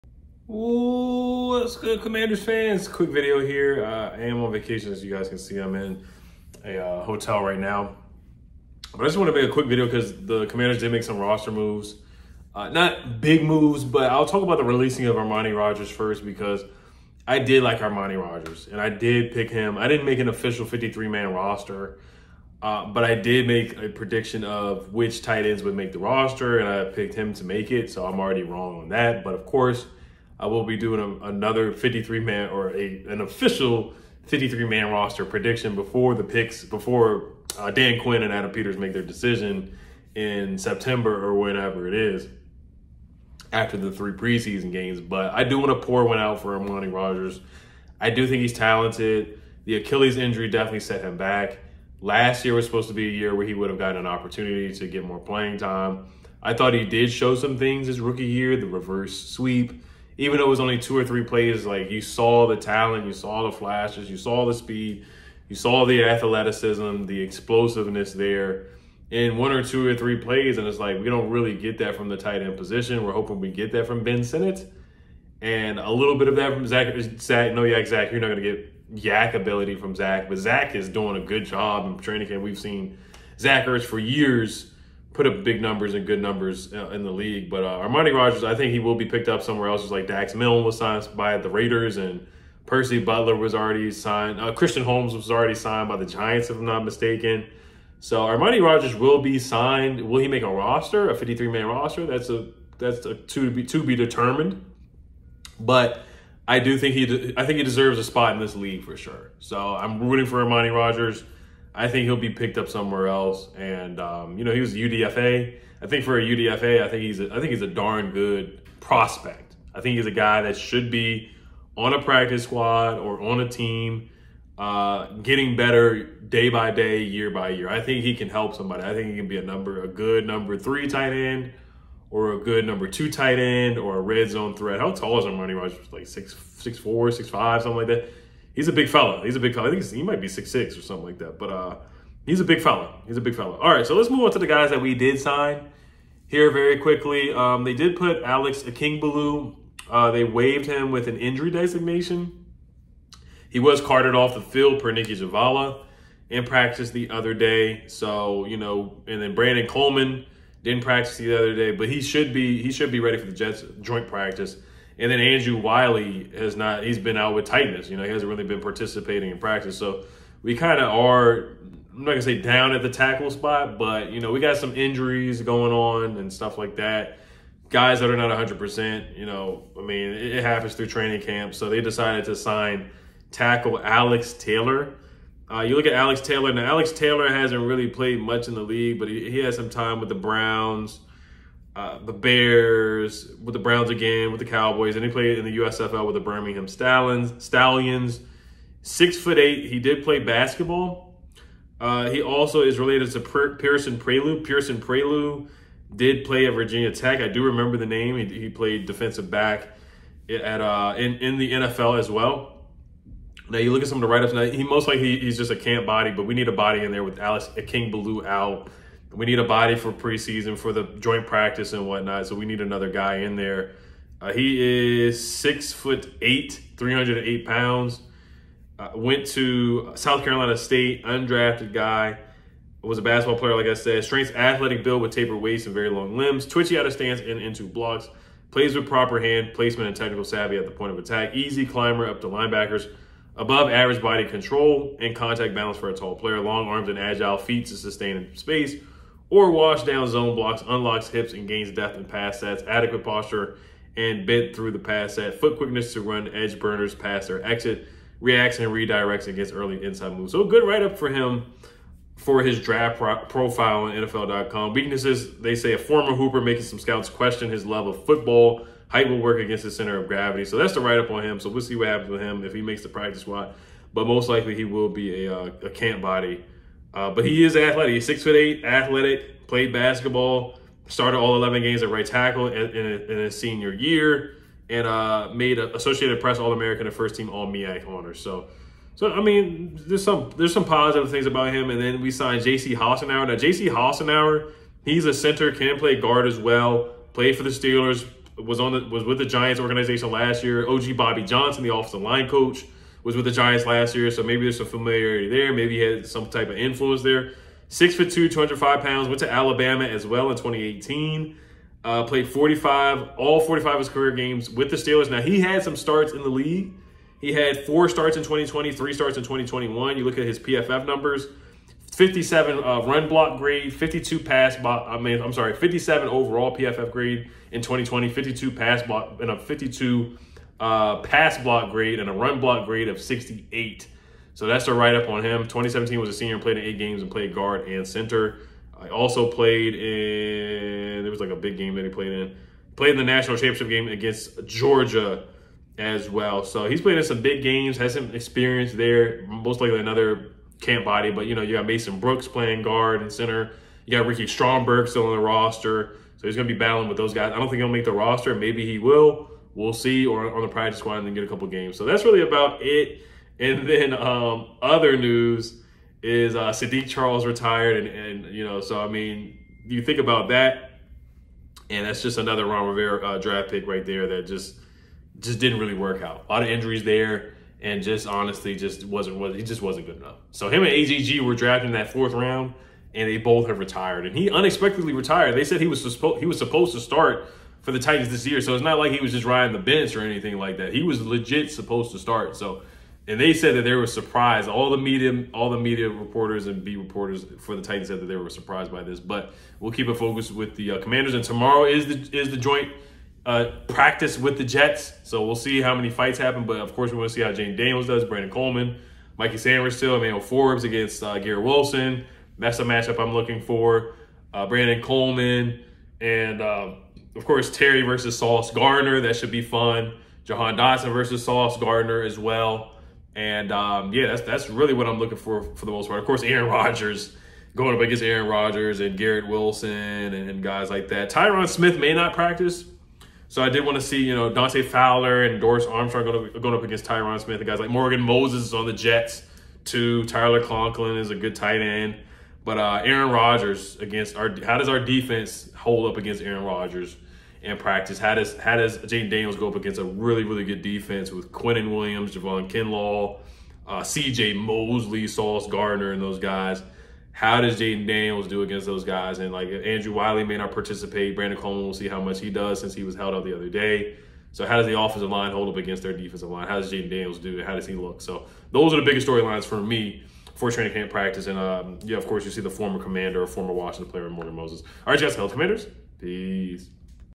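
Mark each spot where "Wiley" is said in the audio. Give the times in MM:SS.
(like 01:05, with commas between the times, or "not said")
02:45, 07:39.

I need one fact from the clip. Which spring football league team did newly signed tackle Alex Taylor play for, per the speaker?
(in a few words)
Birmingham Stallions.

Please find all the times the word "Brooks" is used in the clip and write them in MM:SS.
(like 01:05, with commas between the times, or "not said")
05:51.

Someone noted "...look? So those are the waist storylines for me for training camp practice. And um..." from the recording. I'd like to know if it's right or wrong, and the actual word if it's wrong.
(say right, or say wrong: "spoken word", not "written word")
wrong: "biggest", not "waist".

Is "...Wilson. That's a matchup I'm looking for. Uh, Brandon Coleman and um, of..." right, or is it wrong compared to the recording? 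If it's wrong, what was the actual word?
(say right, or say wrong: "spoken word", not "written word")
right.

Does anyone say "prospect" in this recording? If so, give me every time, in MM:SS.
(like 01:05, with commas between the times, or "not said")
01:58.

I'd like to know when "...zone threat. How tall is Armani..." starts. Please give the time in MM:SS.
02:14.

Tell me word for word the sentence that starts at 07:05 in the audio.
Of course, Aaron Rodgers going up against Aaron Rodgers and Garrett Wilson and, and guys like that.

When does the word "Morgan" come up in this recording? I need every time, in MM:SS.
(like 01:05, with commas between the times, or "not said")
07:17, 07:54.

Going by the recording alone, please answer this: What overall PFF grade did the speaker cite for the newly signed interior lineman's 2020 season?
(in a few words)
57.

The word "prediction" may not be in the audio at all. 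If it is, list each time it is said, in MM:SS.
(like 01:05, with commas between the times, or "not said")
00:23, 00:35.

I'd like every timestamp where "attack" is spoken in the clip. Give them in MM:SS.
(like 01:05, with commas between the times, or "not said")
04:00.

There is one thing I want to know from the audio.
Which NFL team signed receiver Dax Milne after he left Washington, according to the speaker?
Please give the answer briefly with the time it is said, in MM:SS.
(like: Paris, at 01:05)
Raiders, at 01:31.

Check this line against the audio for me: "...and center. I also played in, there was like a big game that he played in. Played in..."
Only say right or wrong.
right.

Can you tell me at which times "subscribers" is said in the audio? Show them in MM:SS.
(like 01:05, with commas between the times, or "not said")
not said.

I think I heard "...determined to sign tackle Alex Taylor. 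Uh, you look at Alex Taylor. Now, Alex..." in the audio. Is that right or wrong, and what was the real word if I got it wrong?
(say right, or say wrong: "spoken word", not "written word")
wrong: "decided", not "determined".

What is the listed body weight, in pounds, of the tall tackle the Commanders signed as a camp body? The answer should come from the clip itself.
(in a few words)
308.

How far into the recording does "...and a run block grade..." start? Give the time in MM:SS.
05:31.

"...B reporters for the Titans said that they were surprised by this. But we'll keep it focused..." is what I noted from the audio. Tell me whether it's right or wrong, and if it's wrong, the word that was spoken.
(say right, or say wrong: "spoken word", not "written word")
right.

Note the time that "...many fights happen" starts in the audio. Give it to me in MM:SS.
06:45.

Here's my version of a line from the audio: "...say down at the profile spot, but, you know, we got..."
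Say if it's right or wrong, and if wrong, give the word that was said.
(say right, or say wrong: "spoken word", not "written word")
wrong: "tackle", not "profile".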